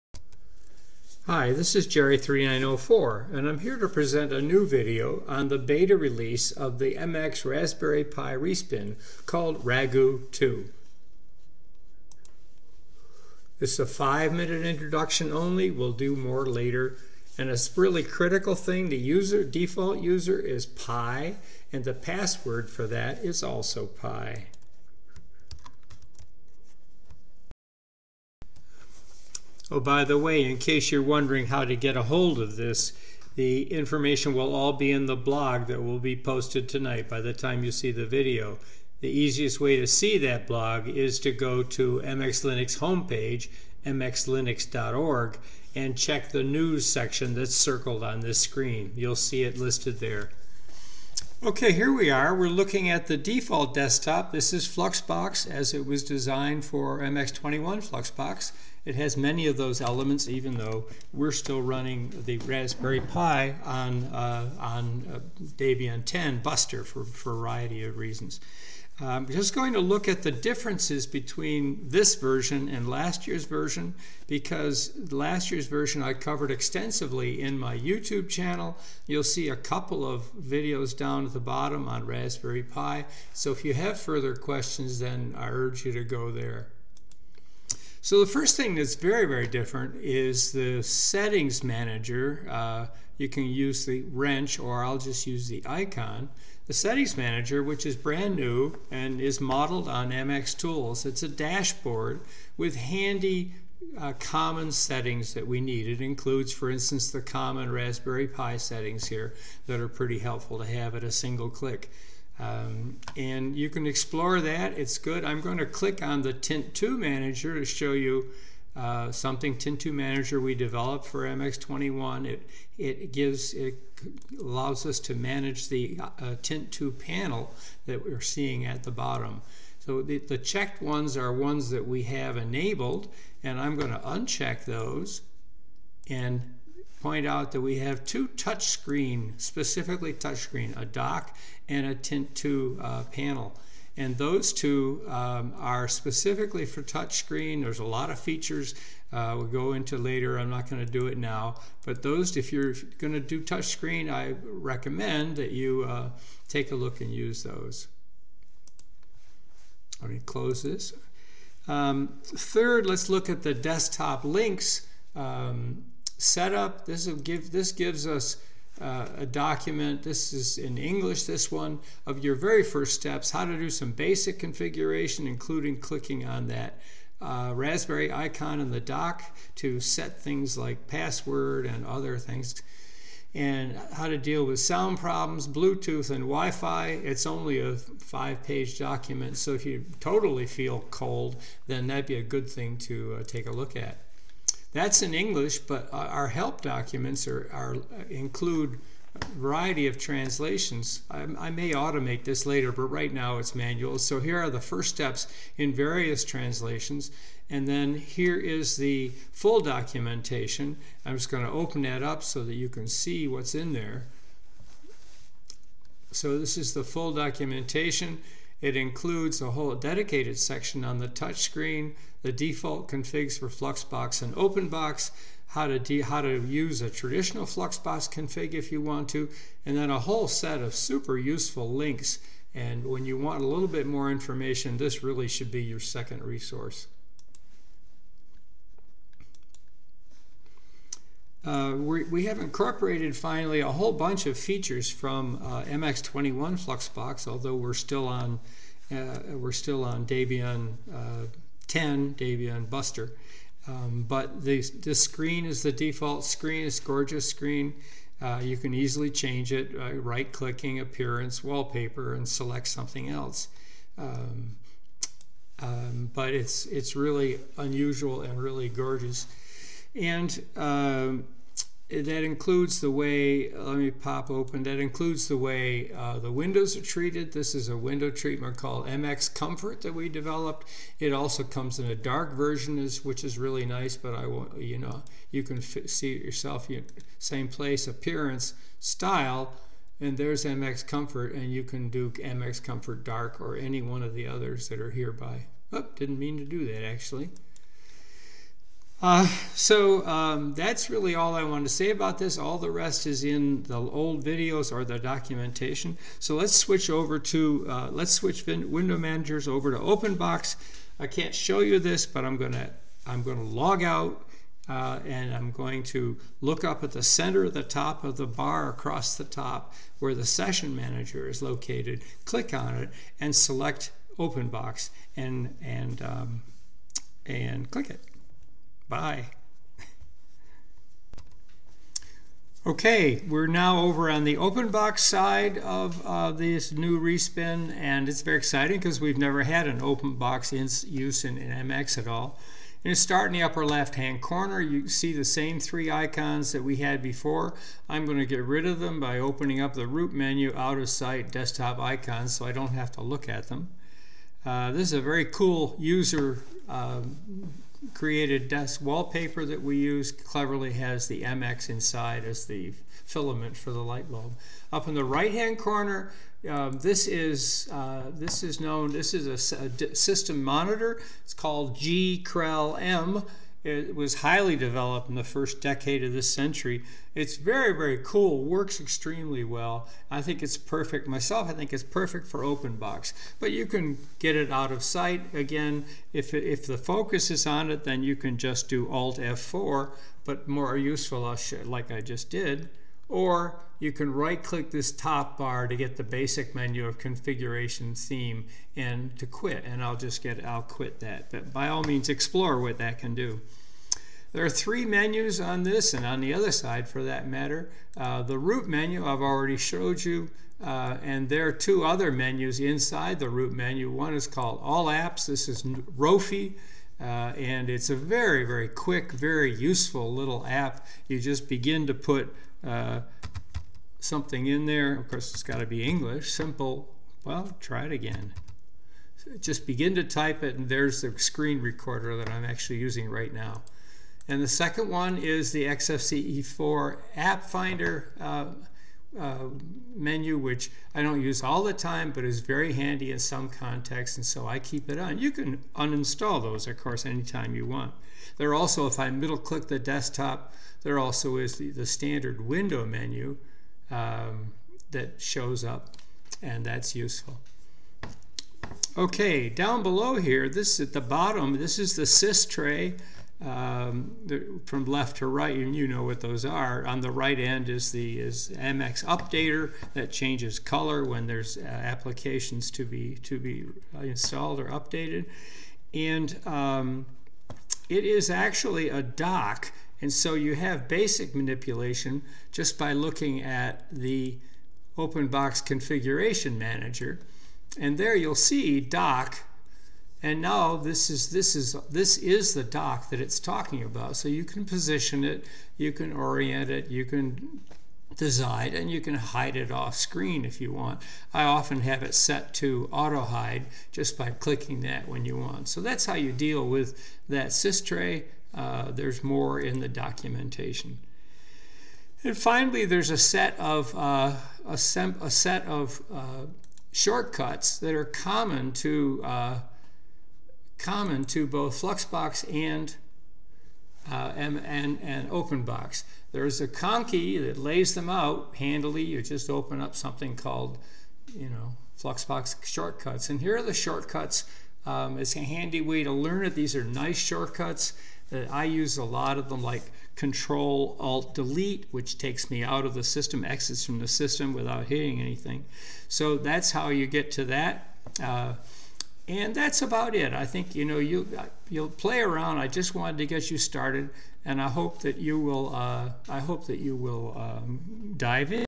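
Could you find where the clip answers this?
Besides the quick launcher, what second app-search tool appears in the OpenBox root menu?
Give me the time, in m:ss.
7:15.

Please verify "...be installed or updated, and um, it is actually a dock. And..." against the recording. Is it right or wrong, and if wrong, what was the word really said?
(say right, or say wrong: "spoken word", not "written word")
right.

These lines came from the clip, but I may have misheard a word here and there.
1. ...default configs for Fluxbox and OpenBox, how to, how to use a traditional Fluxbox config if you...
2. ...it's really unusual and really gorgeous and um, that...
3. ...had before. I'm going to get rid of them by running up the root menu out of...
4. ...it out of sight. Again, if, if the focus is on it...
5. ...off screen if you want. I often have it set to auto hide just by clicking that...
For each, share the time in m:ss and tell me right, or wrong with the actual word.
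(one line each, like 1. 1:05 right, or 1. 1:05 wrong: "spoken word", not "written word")
1. 3:42 right
2. 4:26 right
3. 5:46 wrong: "opening", not "running"
4. 6:24 right
5. 8:19 right.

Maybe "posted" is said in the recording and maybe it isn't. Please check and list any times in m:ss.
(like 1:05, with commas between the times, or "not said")
0:36.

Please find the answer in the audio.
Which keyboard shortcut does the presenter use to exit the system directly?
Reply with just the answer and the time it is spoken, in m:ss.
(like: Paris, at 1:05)
Control Alt Delete, at 9:00.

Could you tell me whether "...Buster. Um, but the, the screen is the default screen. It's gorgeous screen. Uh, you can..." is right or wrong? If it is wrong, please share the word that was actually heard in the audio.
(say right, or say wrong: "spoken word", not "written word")
right.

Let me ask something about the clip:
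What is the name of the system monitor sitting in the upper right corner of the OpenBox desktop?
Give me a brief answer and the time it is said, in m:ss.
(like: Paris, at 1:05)
GKrellM, at 6:11.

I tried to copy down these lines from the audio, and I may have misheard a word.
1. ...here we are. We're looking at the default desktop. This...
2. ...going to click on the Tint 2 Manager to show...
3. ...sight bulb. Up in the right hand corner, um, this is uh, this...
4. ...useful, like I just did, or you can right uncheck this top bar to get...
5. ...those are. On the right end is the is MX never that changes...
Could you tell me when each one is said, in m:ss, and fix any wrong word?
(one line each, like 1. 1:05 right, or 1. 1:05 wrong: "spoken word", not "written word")
1. 0:51 right
2. 1:55 right
3. 6:03 wrong: "light", not "sight"
4. 6:30 wrong: "click", not "uncheck"
5. 7:46 wrong: "updater", not "never".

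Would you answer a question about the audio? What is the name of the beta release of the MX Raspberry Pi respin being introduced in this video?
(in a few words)
Ragout 2.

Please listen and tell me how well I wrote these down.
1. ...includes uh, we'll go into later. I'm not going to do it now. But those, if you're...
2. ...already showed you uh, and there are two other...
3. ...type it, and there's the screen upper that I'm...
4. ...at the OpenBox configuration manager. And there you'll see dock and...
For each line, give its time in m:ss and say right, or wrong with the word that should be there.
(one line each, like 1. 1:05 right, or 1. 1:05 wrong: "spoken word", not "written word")
1. 2:28 wrong: "features", not "includes"
2. 6:49 right
3. 7:10 wrong: "recorder", not "upper"
4. 8:03 right.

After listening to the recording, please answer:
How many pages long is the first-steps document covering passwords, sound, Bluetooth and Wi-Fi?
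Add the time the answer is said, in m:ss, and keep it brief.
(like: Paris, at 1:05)
5, at 3:07.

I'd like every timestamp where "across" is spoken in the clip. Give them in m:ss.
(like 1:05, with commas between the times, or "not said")
5:18.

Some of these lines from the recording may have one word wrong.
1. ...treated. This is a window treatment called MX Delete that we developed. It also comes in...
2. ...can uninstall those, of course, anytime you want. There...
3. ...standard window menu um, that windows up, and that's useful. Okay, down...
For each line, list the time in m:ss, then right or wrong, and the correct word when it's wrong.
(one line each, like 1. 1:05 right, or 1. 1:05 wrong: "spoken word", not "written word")
1. 4:36 wrong: "Comfort", not "Delete"
2. 7:25 right
3. 7:31 wrong: "shows", not "windows".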